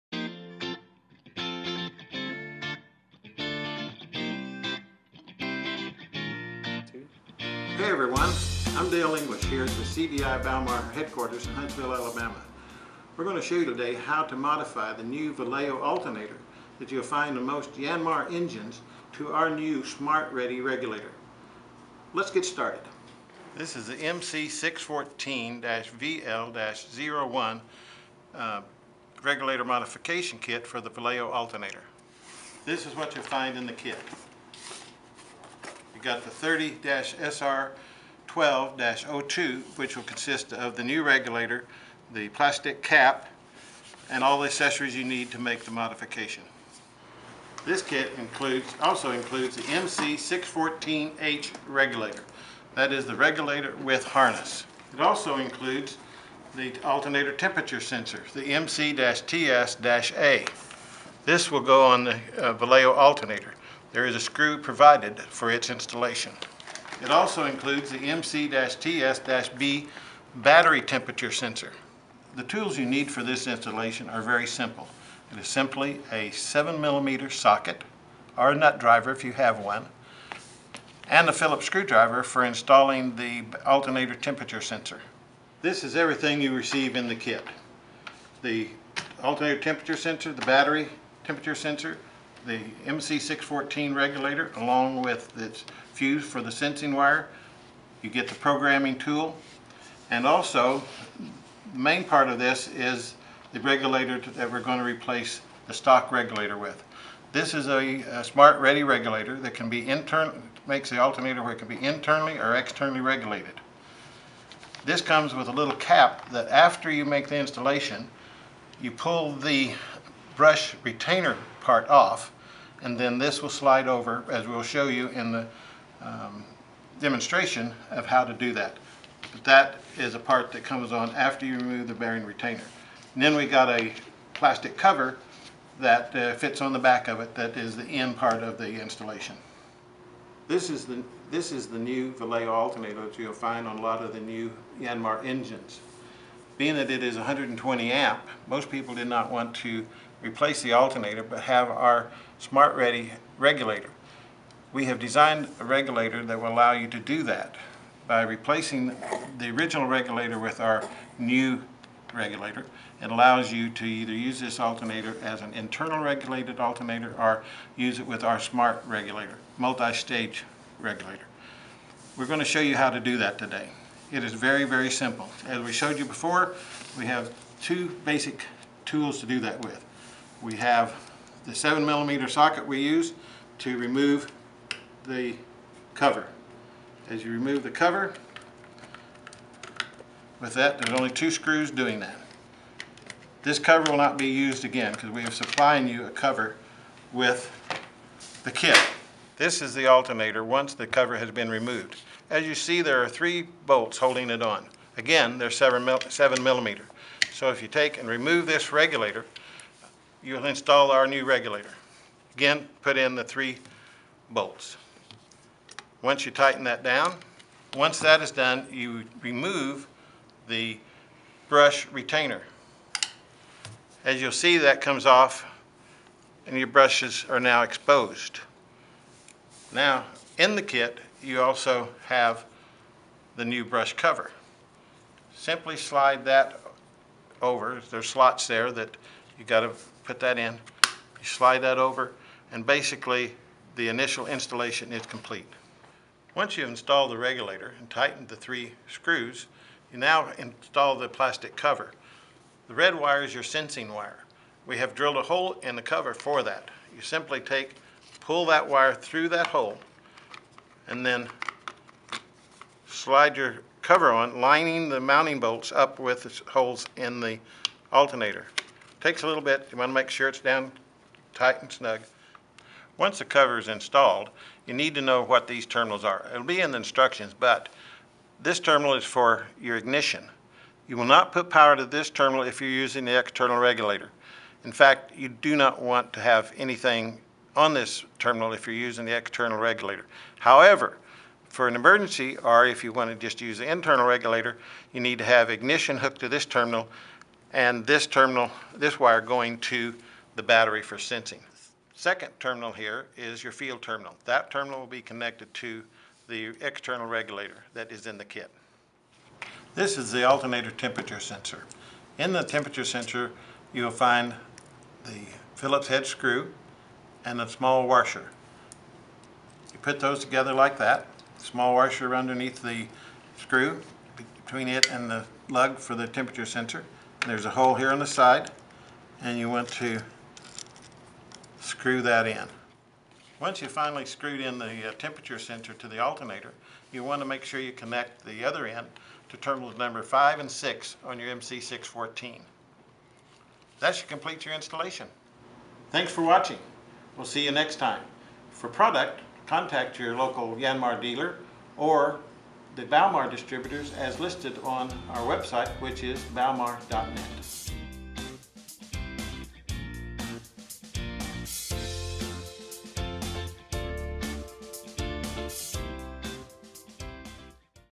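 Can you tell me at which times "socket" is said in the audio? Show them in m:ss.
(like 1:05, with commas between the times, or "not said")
1:17, 3:02.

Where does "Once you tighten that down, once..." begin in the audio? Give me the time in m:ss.
3:36.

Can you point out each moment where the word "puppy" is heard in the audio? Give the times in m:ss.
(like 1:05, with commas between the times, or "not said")
not said.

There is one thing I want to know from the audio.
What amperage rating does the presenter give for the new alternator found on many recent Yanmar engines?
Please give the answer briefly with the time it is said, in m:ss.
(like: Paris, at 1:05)
120 amp, at 2:27.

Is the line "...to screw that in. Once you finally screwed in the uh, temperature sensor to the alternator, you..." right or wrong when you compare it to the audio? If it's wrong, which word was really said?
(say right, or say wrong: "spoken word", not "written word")
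right.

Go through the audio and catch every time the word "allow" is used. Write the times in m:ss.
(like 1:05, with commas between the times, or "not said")
2:36, 2:43.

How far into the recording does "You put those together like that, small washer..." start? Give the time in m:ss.
5:19.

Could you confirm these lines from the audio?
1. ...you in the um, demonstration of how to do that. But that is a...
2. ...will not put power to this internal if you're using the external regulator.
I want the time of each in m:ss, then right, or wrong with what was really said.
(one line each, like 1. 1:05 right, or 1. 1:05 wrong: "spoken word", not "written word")
1. 2:04 right
2. 4:40 wrong: "terminal", not "internal".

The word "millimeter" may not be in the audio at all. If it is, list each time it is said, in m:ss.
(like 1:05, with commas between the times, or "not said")
1:16, 3:01, 3:26.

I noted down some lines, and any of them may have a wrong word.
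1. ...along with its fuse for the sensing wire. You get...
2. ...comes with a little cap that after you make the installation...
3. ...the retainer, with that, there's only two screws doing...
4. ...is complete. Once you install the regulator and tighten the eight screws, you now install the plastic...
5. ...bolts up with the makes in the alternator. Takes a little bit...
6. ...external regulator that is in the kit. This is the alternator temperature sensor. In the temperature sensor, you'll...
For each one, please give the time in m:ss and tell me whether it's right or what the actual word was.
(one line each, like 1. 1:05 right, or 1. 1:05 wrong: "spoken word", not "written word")
1. 1:34 right
2. 1:55 right
3. 3:07 wrong: "cover", not "retainer"
4. 4:04 wrong: "three", not "eight"
5. 4:25 wrong: "holes", not "makes"
6. 5:06 right.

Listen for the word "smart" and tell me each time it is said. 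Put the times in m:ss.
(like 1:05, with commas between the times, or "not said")
0:19, 1:48, 2:32, 2:48.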